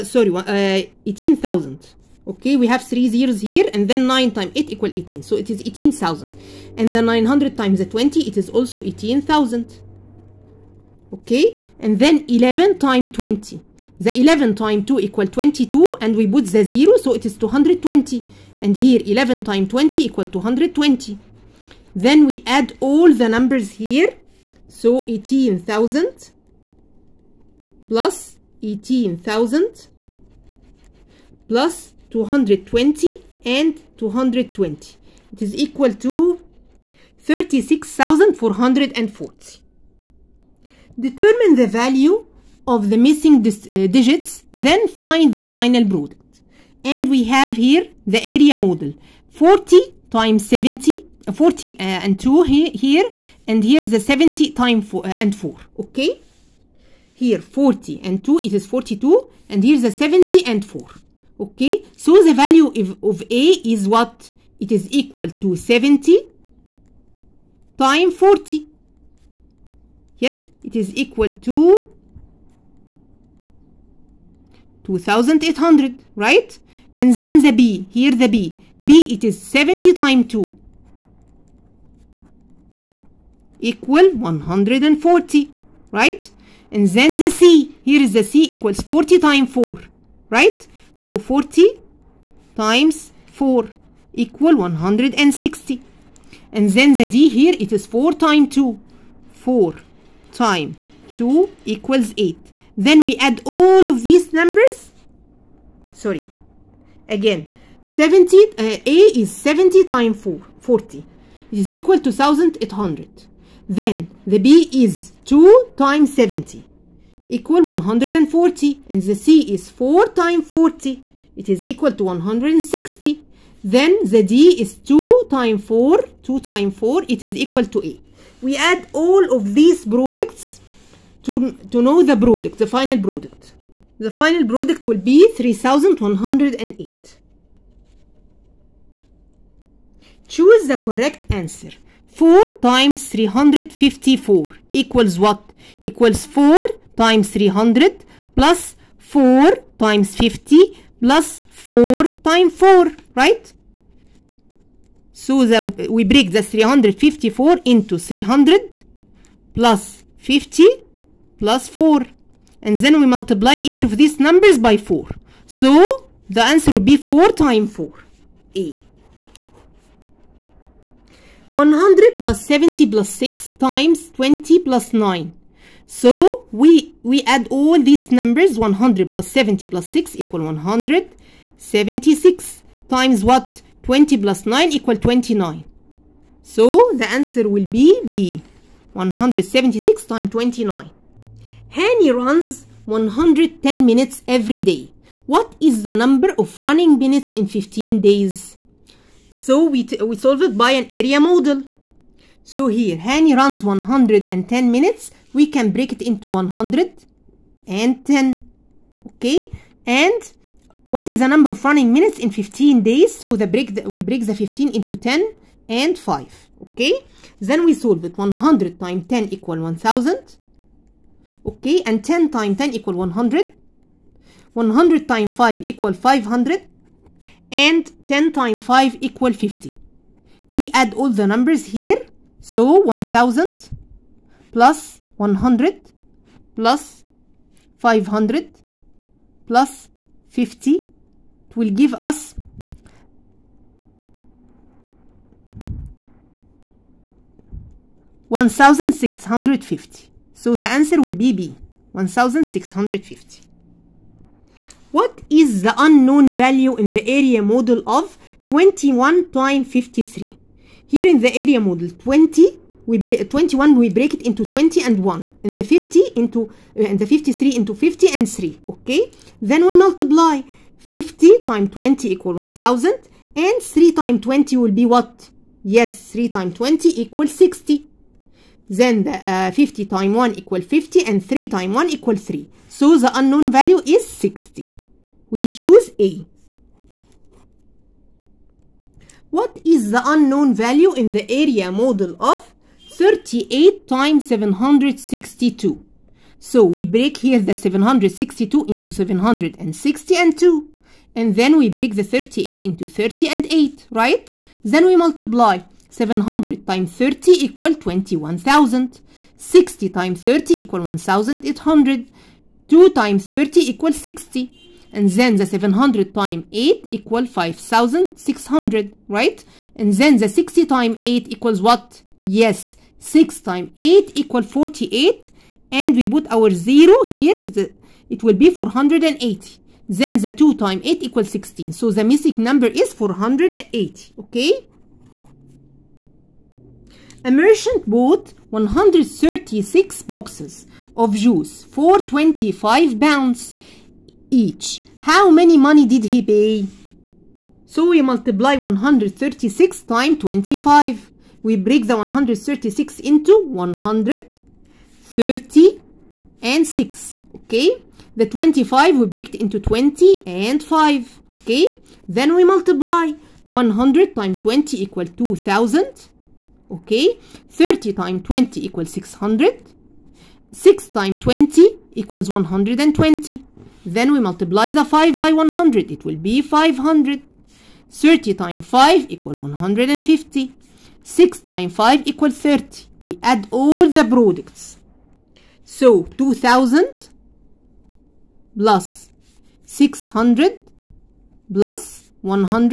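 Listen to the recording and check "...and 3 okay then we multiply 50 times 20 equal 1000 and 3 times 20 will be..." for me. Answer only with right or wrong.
right.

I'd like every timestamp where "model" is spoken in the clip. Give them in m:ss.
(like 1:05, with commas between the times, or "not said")
0:48, 3:21, 4:17, 4:21.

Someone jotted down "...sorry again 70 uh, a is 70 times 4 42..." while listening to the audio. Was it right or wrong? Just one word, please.
wrong.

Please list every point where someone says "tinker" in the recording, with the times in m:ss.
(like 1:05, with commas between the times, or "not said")
not said.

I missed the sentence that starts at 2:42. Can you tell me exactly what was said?
And then we multiply each of these numbers by 4.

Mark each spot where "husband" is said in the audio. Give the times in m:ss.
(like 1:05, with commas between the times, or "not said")
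not said.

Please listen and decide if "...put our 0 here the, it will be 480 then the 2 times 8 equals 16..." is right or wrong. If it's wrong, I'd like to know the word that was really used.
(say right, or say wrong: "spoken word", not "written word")
right.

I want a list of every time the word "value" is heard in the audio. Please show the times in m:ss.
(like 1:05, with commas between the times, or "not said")
0:41, 1:02, 4:16, 4:43.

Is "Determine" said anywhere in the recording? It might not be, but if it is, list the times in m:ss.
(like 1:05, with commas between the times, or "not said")
0:40.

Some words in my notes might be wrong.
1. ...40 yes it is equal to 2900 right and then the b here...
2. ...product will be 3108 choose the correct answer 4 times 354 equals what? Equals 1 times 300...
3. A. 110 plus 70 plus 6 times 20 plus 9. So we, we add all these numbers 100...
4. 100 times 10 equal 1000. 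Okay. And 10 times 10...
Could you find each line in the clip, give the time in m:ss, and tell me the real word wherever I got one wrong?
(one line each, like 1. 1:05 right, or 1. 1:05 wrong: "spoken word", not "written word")
1. 1:08 wrong: "2800", not "2900"
2. 2:14 wrong: "4", not "1"
3. 2:48 wrong: "100", not "110"
4. 3:38 right.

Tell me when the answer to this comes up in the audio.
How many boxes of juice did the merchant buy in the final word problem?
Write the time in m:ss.
5:38.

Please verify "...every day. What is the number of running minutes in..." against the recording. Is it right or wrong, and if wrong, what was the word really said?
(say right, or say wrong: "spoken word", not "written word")
right.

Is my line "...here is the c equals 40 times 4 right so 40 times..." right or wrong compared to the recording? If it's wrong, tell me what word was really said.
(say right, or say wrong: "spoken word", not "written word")
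right.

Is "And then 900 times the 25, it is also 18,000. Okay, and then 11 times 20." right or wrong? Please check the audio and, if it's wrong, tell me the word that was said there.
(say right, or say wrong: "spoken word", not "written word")
wrong: "20", not "25".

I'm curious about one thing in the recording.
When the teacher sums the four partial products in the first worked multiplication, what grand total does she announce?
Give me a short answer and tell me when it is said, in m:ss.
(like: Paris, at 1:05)
36,440, at 0:37.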